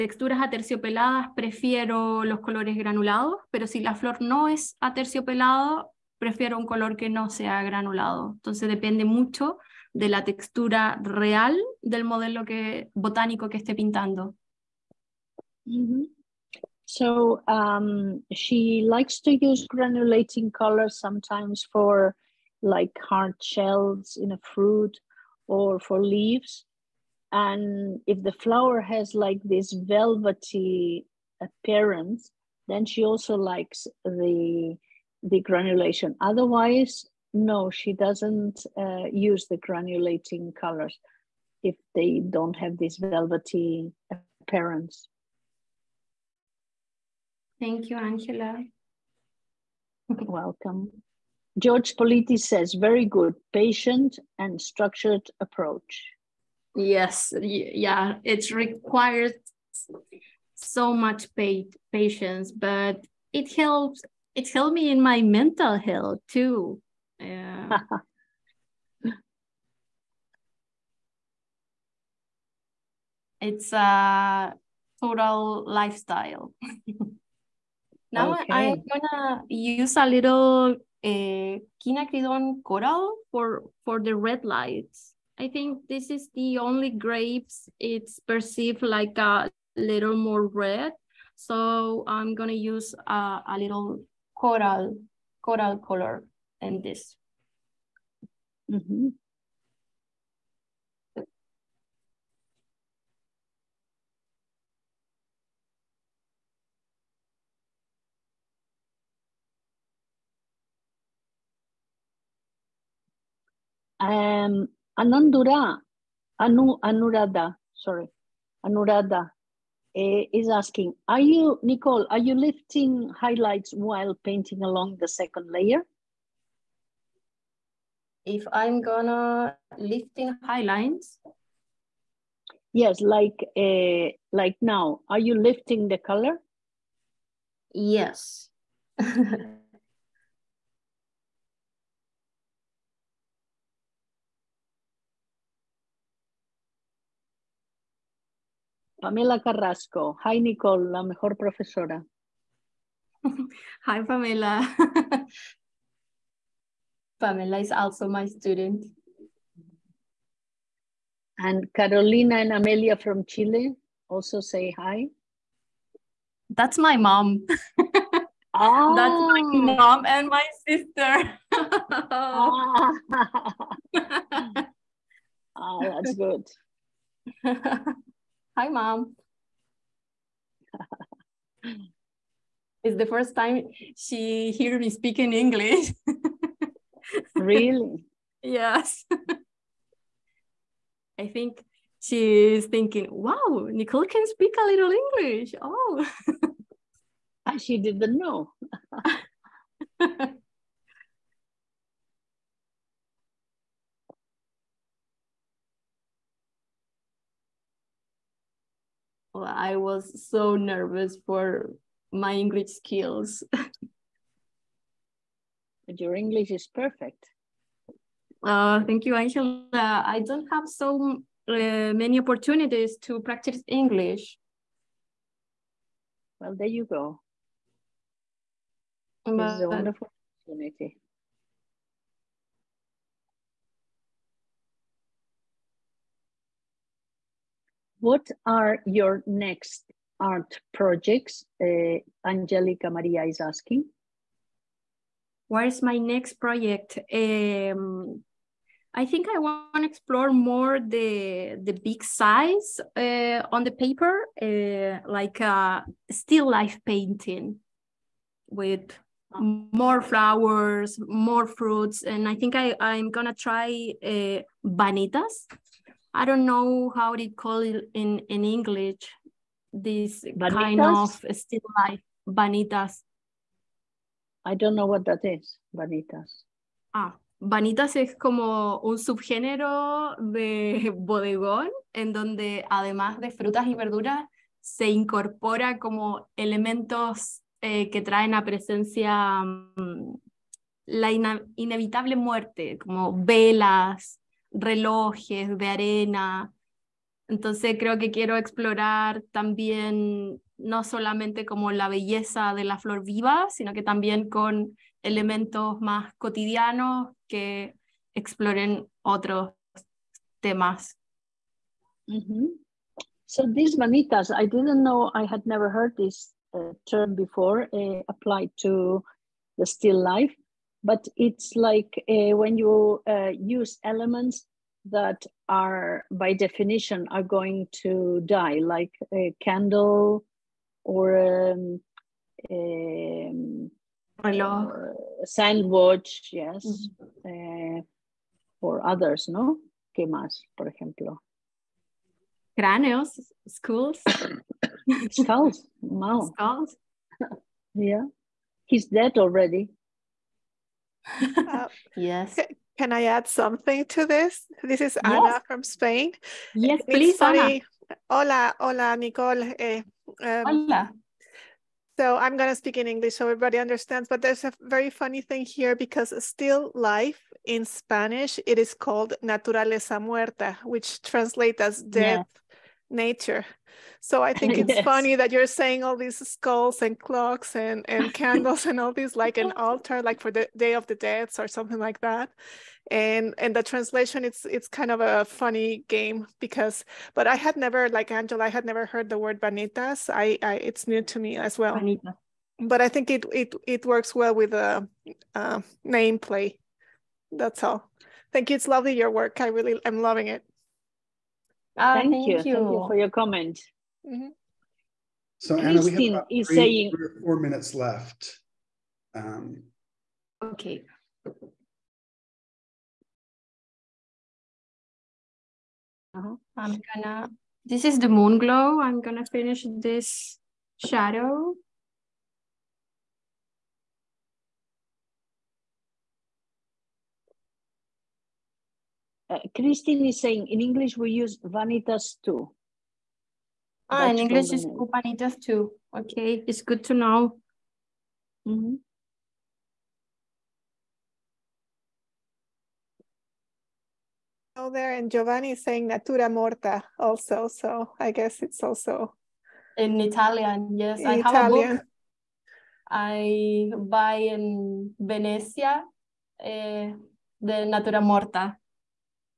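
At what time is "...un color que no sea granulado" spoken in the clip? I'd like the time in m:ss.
0:06.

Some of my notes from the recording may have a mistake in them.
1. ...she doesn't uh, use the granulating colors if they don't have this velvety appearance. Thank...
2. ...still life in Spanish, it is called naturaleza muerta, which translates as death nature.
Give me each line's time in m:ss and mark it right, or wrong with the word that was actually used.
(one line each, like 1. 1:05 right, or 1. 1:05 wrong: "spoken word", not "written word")
1. 0:37 right
2. 6:06 right.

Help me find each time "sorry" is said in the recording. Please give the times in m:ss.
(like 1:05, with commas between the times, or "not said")
1:57.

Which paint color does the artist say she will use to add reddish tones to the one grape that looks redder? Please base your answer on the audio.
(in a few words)
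Quinacridone coral.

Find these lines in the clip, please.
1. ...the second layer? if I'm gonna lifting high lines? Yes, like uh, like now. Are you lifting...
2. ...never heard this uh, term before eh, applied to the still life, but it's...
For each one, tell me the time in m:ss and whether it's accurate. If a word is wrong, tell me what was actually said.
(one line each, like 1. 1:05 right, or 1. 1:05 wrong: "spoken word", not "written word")
1. 2:05 right
2. 5:15 right.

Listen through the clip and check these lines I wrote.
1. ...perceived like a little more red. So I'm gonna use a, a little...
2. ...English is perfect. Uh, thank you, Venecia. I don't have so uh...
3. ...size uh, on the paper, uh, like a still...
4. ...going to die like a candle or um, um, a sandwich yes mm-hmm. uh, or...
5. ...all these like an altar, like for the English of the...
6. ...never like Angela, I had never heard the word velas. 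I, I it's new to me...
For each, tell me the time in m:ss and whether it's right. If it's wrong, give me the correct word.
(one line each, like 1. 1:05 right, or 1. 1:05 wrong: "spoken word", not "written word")
1. 1:28 right
2. 3:36 wrong: "Angela", not "Venecia"
3. 4:12 right
4. 5:27 right
5. 6:18 wrong: "Day", not "English"
6. 6:27 wrong: "banitas", not "velas".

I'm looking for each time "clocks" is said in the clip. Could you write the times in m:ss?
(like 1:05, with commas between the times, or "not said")
6:16.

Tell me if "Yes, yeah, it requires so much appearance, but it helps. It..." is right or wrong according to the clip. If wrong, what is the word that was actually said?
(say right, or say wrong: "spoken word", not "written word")
wrong: "patience", not "appearance".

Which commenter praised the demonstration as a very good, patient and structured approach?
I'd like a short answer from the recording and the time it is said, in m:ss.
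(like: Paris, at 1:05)
George Politi, at 0:51.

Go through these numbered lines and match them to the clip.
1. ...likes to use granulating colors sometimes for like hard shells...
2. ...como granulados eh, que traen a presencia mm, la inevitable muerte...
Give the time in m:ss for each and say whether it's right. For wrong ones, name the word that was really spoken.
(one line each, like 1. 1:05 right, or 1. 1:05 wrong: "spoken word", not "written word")
1. 0:18 right
2. 4:45 wrong: "elementos", not "granulados".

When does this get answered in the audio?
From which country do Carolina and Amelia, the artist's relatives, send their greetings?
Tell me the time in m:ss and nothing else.
2:43.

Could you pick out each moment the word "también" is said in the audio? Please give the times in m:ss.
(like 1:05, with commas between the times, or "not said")
4:59, 5:03.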